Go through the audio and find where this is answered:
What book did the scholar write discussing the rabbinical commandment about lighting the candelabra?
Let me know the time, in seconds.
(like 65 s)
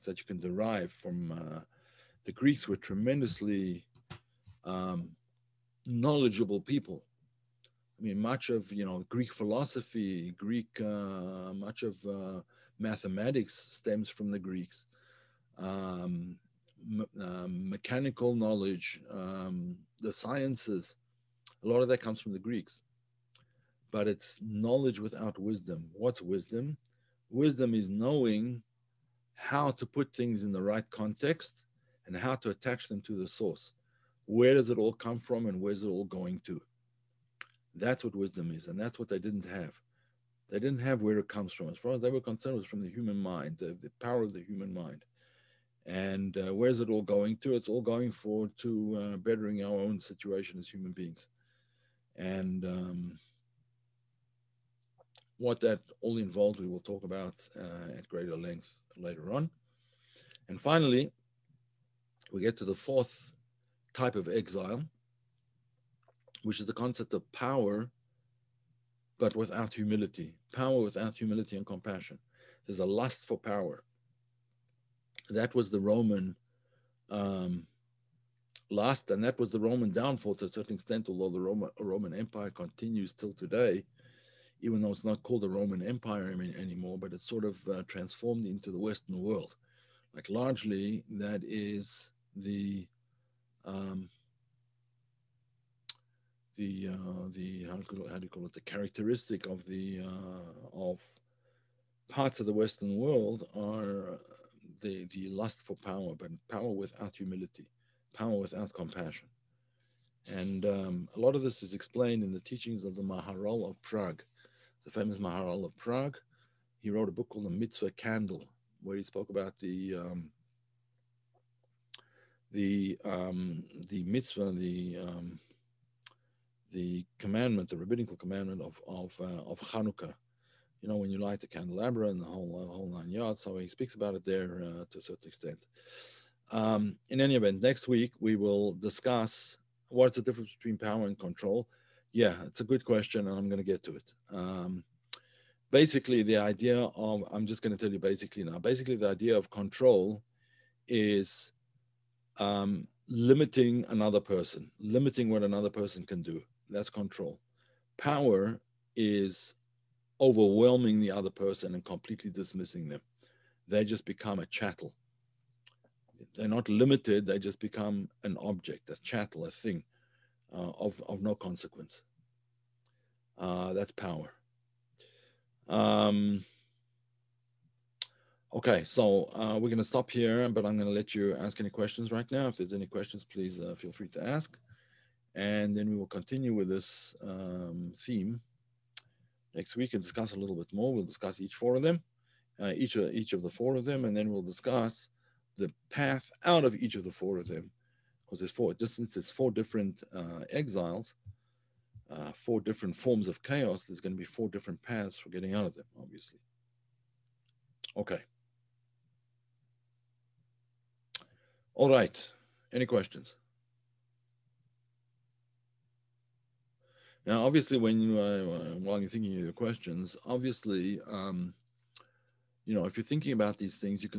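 117 s.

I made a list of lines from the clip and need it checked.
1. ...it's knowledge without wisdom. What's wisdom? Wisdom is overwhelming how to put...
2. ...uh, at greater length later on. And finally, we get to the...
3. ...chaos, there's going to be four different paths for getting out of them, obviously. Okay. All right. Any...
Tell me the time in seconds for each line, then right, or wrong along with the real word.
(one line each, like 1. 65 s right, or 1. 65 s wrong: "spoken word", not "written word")
1. 24 s wrong: "knowing", not "overwhelming"
2. 57 s right
3. 203 s right.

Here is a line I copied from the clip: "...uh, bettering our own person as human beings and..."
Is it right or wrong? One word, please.
wrong.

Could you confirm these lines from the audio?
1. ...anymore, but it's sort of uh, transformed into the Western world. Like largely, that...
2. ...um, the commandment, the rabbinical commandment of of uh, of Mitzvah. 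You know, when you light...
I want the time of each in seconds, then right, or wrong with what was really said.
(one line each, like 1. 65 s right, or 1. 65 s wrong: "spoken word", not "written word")
1. 86 s right
2. 125 s wrong: "Hanukkah", not "Mitzvah".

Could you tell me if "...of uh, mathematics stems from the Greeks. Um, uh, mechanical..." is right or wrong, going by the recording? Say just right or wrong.
right.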